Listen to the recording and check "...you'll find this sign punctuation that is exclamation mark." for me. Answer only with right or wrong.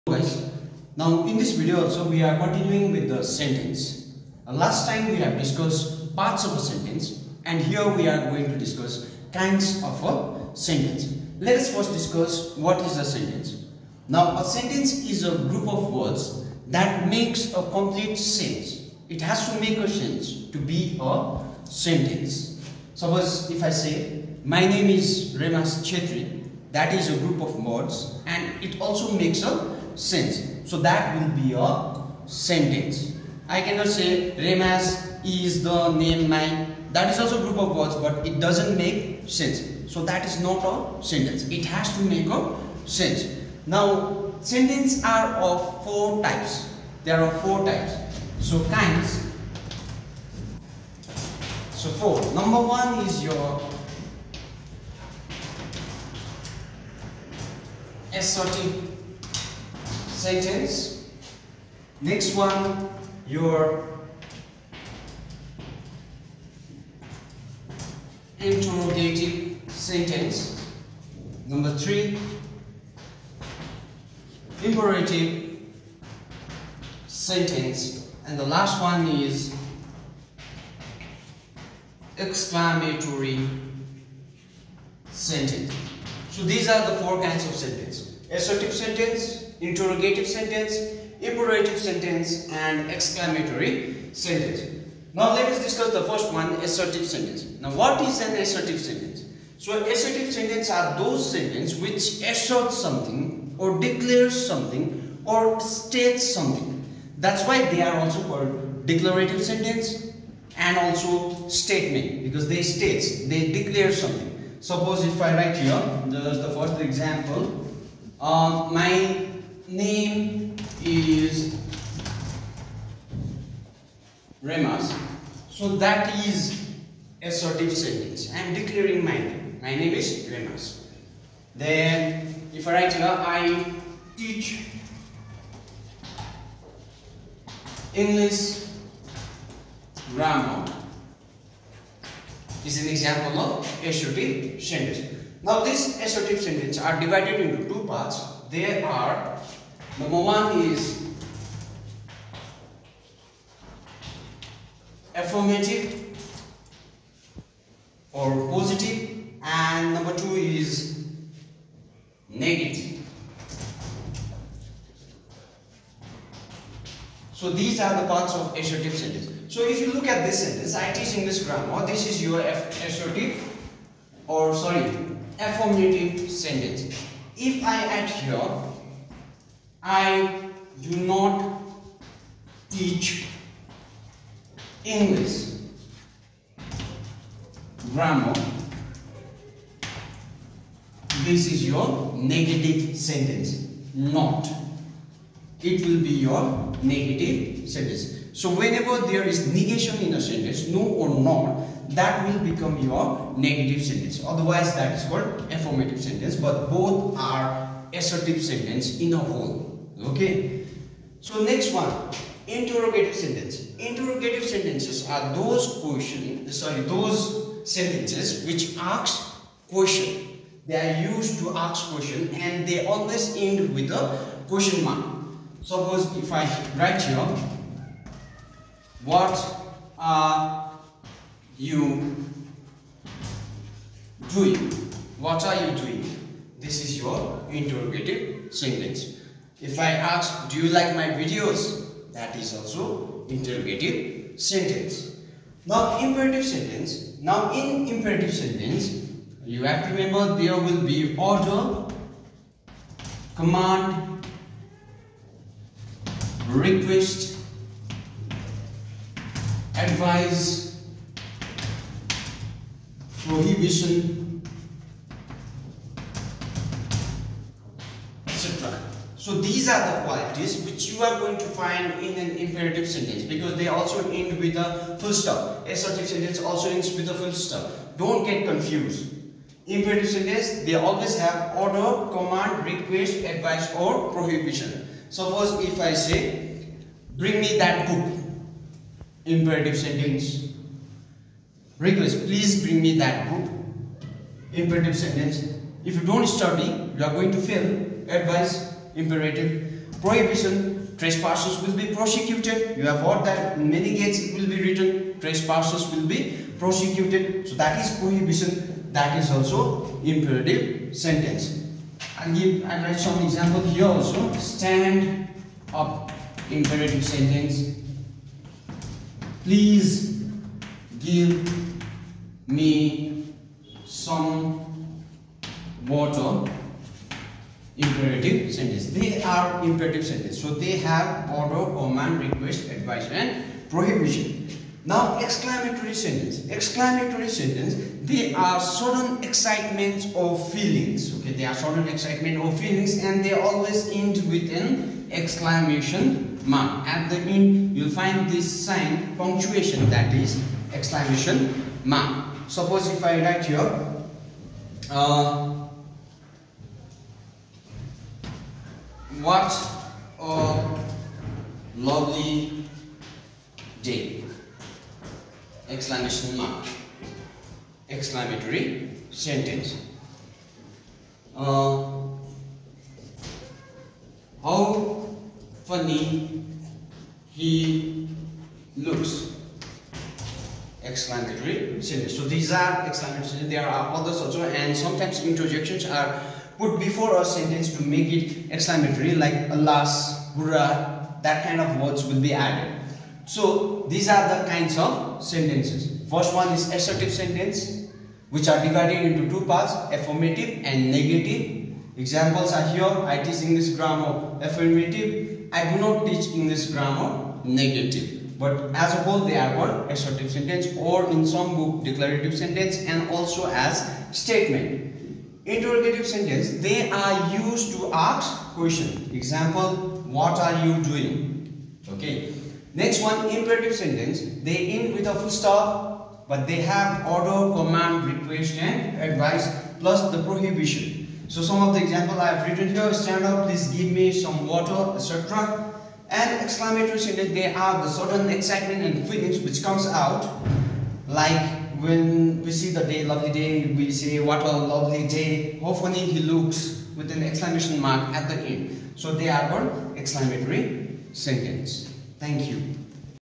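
right.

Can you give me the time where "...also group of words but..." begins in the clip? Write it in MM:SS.
00:37.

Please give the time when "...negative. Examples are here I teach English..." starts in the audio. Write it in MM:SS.
06:40.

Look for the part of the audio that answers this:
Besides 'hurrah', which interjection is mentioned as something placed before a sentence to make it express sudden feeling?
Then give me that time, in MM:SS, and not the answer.
06:29.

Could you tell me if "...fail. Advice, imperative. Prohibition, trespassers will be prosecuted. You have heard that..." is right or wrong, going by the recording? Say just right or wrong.
right.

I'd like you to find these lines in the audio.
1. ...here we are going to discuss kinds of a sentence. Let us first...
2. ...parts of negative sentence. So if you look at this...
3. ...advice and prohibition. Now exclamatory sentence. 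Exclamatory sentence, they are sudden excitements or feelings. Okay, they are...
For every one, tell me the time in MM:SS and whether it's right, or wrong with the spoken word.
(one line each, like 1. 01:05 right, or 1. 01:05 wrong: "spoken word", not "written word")
1. 00:07 right
2. 02:48 wrong: "assertive", not "negative"
3. 05:32 right.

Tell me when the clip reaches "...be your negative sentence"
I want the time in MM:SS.
03:16.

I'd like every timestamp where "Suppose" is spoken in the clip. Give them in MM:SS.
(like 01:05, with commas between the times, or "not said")
00:22, 01:54, 03:45, 04:45, 05:52.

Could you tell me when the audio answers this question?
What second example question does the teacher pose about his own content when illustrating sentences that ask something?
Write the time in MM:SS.
04:00.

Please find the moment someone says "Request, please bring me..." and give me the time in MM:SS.
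04:51.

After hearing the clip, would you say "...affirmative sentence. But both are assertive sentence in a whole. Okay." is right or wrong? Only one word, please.
right.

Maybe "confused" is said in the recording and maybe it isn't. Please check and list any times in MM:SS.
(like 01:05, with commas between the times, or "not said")
04:38.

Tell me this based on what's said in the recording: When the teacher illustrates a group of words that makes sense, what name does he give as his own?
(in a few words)
Remas Chetri.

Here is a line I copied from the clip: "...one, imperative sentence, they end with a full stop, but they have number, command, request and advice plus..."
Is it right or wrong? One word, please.
wrong.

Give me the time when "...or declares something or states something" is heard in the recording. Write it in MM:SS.
01:43.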